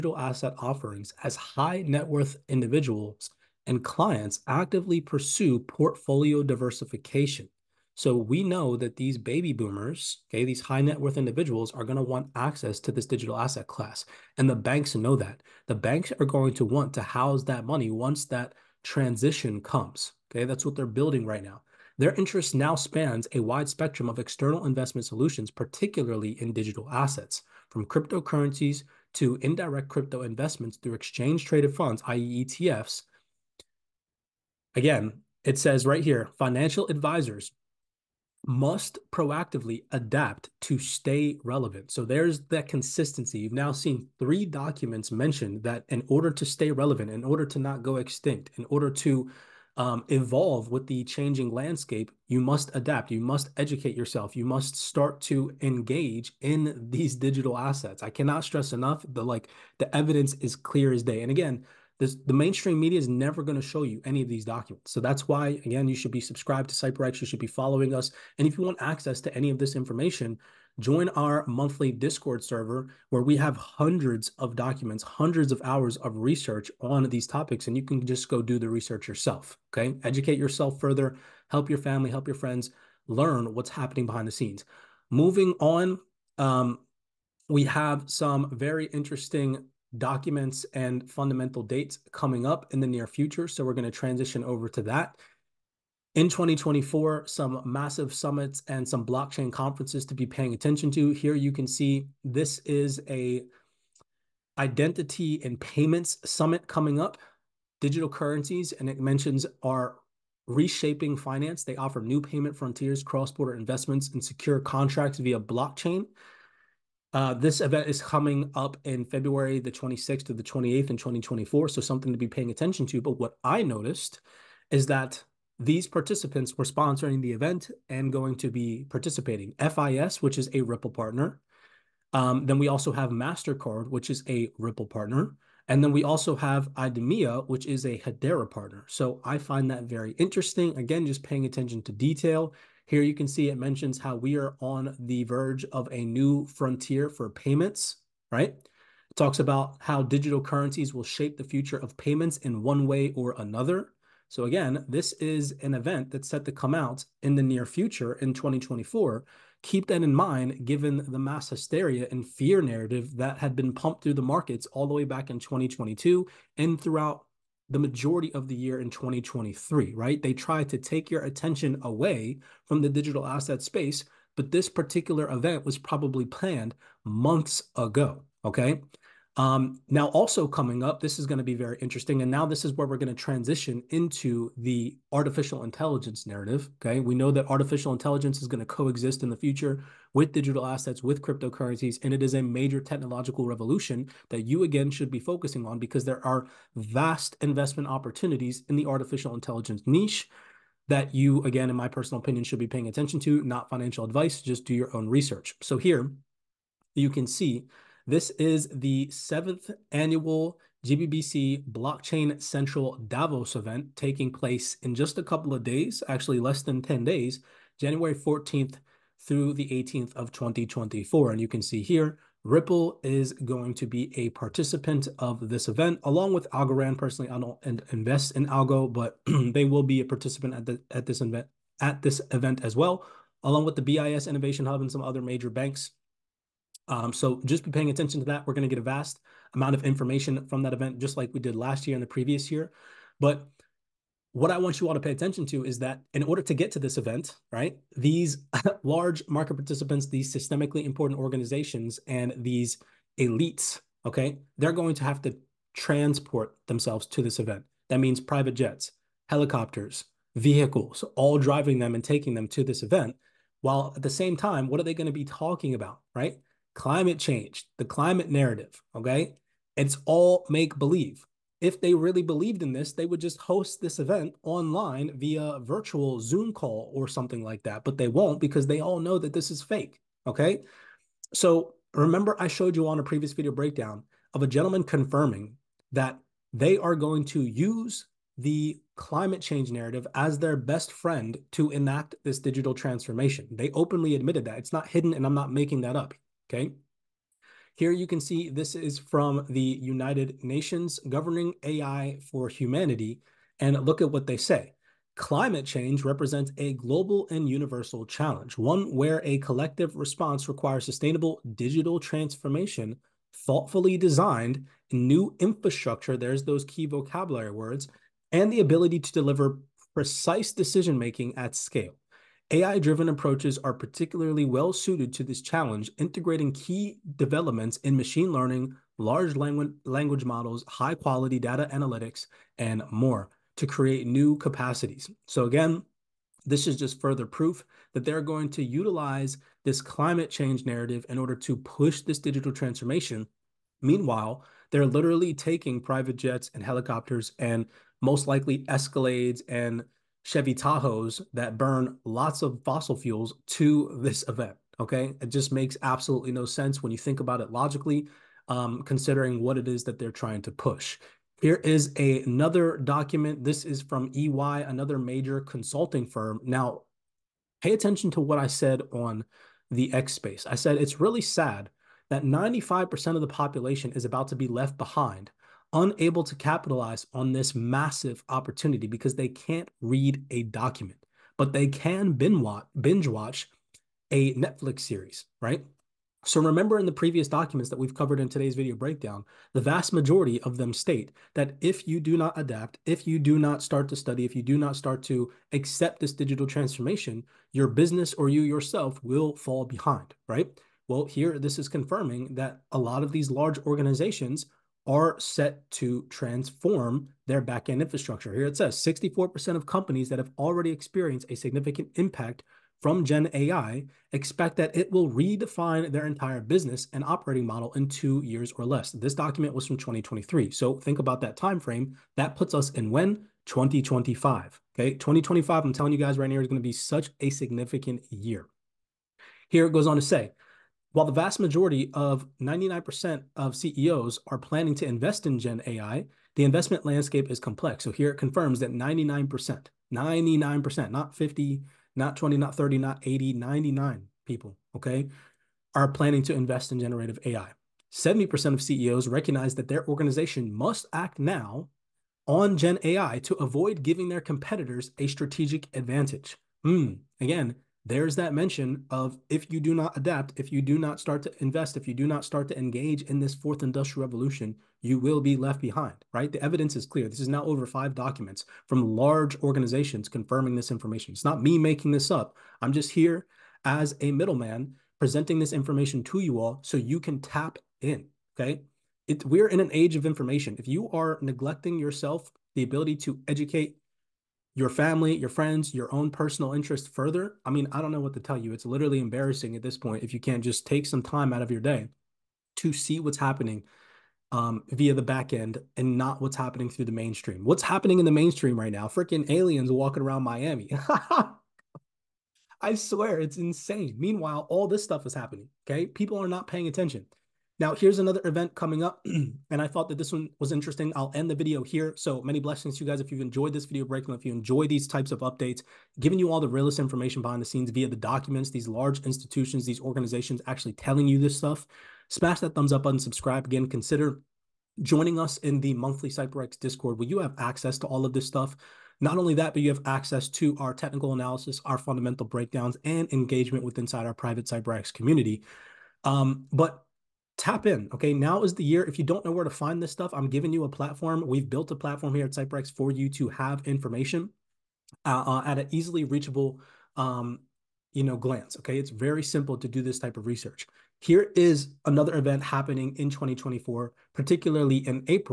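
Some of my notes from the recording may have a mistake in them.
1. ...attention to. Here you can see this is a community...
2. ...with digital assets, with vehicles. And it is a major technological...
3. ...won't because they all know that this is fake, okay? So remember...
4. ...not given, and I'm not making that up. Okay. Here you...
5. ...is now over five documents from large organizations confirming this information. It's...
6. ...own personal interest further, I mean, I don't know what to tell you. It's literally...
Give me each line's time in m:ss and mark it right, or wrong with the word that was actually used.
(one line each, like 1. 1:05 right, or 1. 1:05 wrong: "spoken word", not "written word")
1. 1:40 wrong: "identity", not "community"
2. 3:10 wrong: "cryptocurrencies", not "vehicles"
3. 4:38 right
4. 4:54 wrong: "hidden", not "given"
5. 7:47 right
6. 8:05 right.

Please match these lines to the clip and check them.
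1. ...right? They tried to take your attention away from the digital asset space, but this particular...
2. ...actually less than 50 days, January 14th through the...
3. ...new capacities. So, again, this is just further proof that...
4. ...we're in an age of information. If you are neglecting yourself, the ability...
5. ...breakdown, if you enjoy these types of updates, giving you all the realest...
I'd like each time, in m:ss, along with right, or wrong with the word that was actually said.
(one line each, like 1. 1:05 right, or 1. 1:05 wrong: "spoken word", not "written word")
1. 2:49 right
2. 3:36 wrong: "10", not "50"
3. 5:34 right
4. 7:59 right
5. 8:33 right.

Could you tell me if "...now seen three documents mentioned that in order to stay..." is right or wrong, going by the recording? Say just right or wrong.
right.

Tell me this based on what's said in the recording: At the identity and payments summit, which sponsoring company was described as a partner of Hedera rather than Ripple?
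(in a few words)
IDEMIA.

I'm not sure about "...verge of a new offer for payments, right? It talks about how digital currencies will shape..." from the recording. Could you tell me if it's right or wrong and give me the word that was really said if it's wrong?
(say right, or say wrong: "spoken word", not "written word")
wrong: "frontier", not "offer".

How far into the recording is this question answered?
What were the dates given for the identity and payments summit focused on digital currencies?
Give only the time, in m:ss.
1:59.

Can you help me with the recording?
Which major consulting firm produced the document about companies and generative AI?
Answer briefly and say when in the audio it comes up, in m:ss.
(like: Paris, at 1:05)
EY, at 6:04.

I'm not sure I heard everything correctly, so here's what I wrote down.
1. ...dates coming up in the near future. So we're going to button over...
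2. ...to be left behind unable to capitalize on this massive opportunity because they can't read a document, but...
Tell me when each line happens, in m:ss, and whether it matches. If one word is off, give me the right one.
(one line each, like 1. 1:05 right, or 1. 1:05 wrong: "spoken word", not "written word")
1. 1:31 wrong: "transition", not "button"
2. 6:14 right.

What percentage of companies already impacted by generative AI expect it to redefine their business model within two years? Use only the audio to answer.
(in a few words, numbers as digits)
64%.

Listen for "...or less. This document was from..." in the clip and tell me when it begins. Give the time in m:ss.
6:58.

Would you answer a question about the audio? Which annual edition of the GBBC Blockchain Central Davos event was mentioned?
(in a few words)
7th.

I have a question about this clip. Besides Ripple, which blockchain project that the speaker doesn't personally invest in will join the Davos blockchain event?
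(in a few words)
Algorand.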